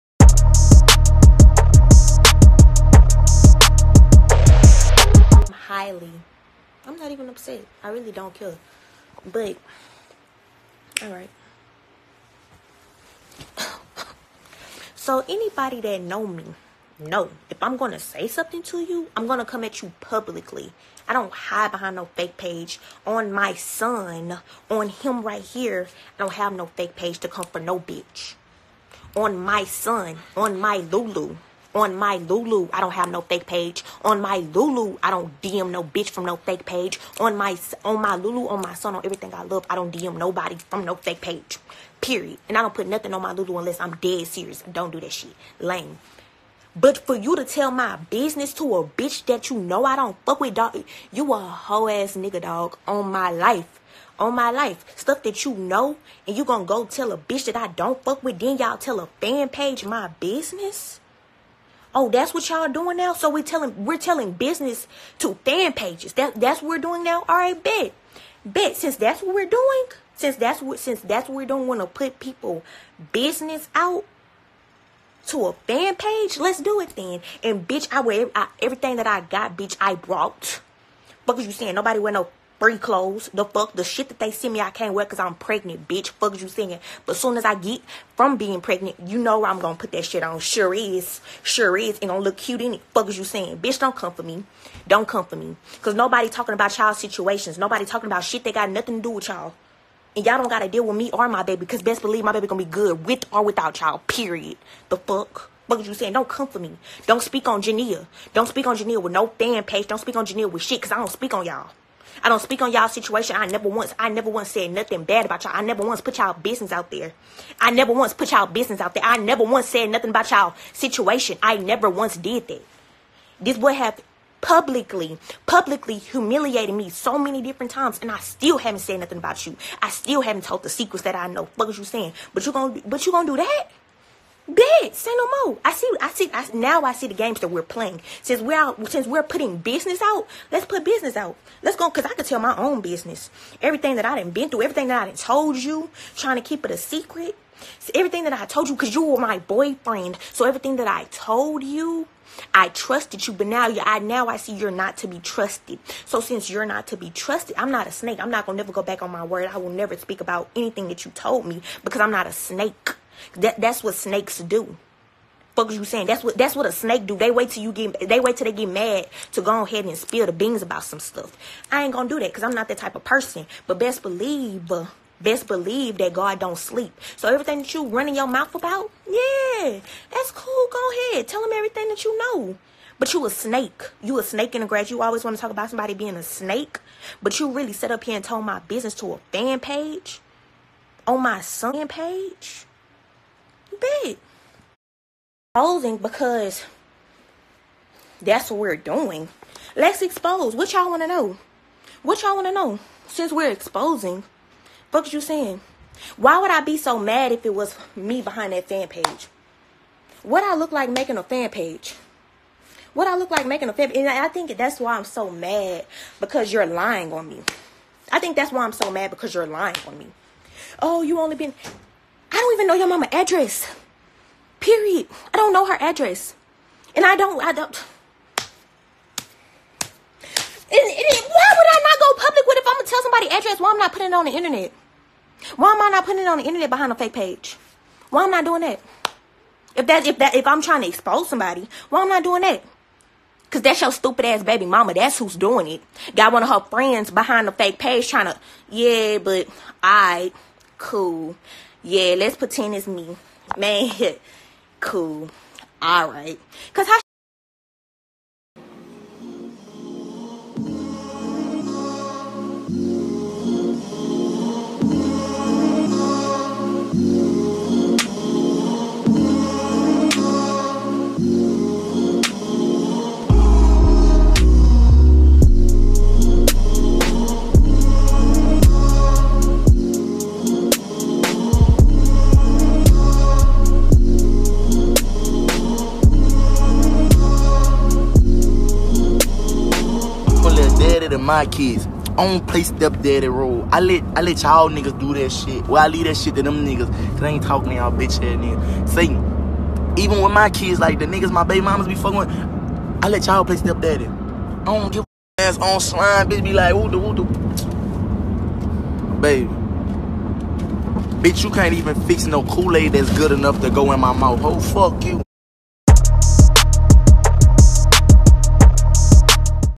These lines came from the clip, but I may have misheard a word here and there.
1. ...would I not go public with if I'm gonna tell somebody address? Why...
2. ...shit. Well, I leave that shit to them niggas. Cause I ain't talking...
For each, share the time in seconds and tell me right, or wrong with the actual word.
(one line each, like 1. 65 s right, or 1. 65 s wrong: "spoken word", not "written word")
1. 231 s right
2. 295 s right.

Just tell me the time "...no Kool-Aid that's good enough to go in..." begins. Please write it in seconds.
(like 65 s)
312 s.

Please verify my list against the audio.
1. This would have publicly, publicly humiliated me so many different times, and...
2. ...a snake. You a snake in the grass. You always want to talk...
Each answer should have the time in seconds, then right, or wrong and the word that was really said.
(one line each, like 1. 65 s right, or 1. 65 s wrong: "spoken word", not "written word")
1. 123 s right
2. 183 s right.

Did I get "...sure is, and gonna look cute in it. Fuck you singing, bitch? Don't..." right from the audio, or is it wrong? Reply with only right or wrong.
wrong.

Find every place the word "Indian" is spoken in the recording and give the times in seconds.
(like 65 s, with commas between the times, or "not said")
not said.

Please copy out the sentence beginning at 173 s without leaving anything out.
But best believe, best believe that God don't sleep.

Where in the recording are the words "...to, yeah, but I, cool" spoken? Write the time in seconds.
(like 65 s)
248 s.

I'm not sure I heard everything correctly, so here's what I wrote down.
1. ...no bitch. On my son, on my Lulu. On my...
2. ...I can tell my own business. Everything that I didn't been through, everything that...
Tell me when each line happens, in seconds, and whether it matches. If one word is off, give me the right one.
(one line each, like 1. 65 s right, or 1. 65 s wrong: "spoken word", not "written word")
1. 27 s right
2. 142 s right.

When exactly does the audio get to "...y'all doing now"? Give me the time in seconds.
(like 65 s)
62 s.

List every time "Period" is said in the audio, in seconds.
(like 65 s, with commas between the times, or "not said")
42 s, 104 s, 224 s.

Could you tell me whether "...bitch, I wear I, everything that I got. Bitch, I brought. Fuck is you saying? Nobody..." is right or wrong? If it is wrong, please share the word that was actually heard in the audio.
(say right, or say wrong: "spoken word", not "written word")
right.